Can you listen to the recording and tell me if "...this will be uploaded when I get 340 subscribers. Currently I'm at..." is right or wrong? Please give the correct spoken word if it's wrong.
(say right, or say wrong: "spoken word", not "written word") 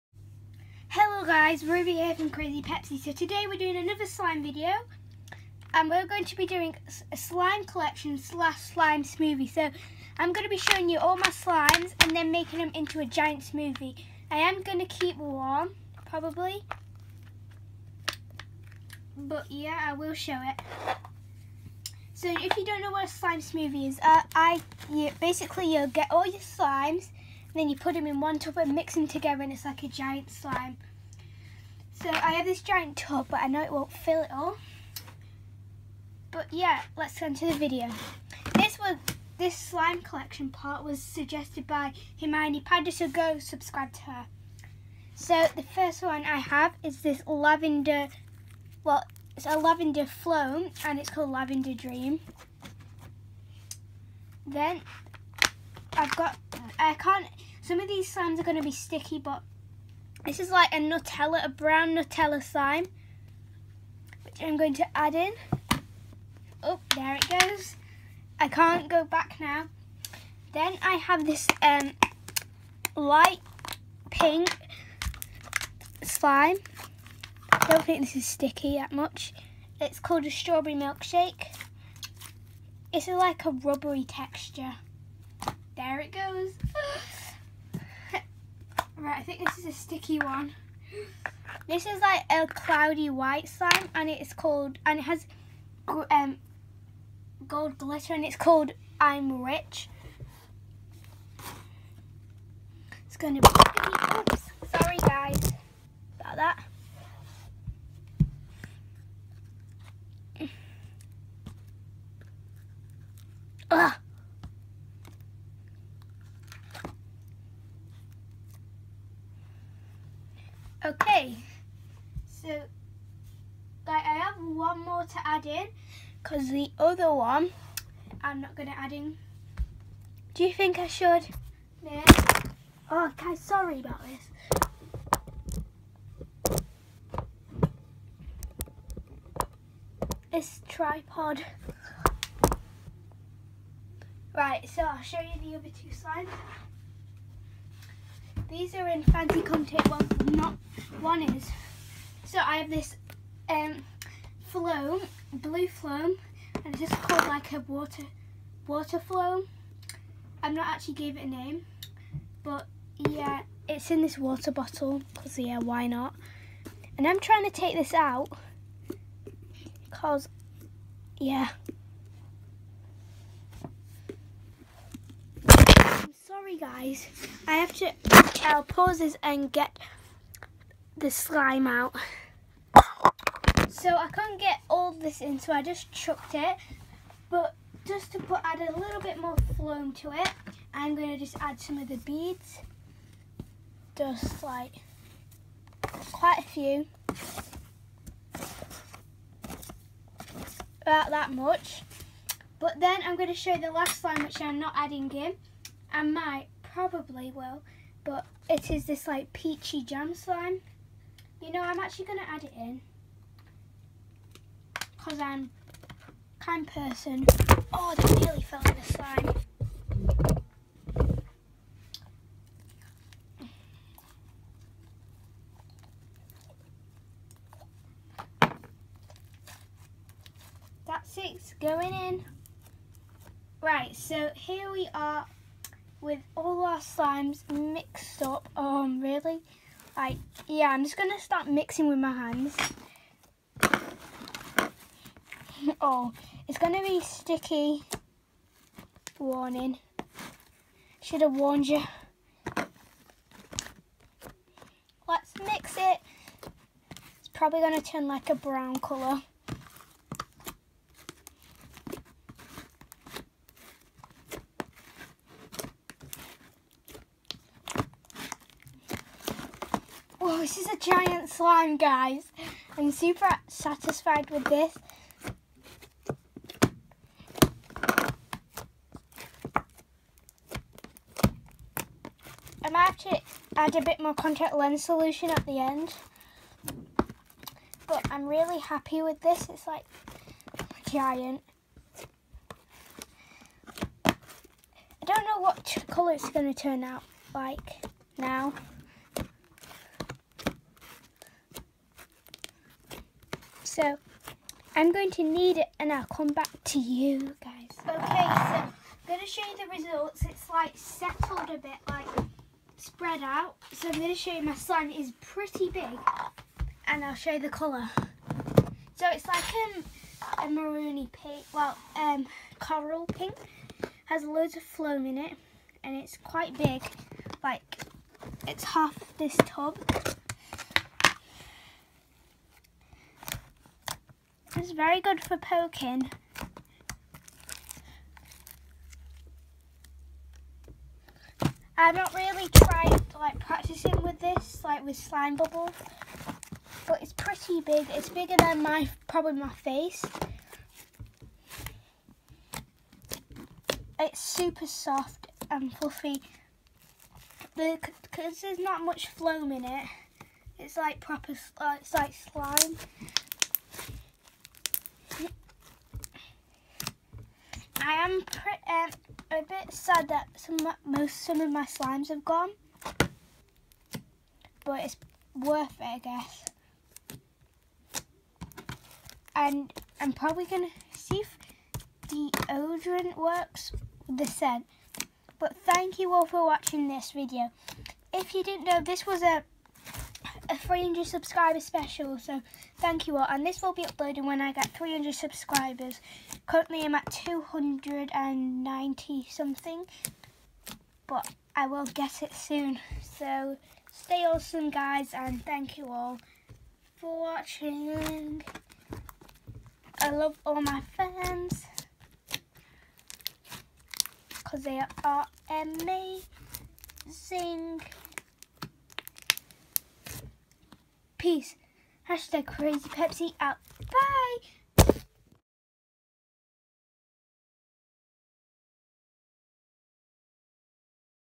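wrong: "300", not "340".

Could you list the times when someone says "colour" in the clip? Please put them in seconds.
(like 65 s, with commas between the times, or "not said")
258 s, 295 s, 317 s.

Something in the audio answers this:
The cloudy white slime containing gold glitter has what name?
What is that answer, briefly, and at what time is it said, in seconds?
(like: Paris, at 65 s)
I'm Rich, at 98 s.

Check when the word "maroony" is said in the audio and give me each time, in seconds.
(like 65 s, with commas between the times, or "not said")
320 s.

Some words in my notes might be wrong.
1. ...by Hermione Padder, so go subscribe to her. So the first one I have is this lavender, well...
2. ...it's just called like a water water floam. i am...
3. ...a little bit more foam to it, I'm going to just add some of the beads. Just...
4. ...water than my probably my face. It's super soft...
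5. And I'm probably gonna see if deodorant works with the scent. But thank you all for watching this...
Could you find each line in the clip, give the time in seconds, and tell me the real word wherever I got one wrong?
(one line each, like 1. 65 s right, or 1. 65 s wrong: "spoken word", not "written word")
1. 41 s right
2. 156 s right
3. 188 s right
4. 348 s wrong: "bigger", not "water"
5. 379 s right.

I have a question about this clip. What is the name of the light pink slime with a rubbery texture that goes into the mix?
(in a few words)
Strawberry Milkshake.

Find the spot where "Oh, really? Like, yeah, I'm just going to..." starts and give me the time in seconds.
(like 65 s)
238 s.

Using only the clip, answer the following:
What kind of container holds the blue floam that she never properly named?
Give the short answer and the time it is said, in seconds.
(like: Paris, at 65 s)
water bottle, at 164 s.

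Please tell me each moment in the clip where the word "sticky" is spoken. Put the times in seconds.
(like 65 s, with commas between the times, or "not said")
58 s, 78 s, 89 s, 247 s.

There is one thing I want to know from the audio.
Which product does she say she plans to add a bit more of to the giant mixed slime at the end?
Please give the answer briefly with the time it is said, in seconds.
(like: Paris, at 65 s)
contact lens solution, at 284 s.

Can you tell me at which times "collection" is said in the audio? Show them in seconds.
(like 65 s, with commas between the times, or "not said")
7 s, 40 s.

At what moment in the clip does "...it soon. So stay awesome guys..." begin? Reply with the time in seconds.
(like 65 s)
402 s.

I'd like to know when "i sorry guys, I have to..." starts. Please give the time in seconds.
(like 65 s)
175 s.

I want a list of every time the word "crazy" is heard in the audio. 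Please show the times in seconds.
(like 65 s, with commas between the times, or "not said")
2 s, 422 s.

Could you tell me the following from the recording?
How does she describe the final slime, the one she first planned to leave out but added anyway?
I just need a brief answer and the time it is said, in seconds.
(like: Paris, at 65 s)
peachy jam, at 209 s.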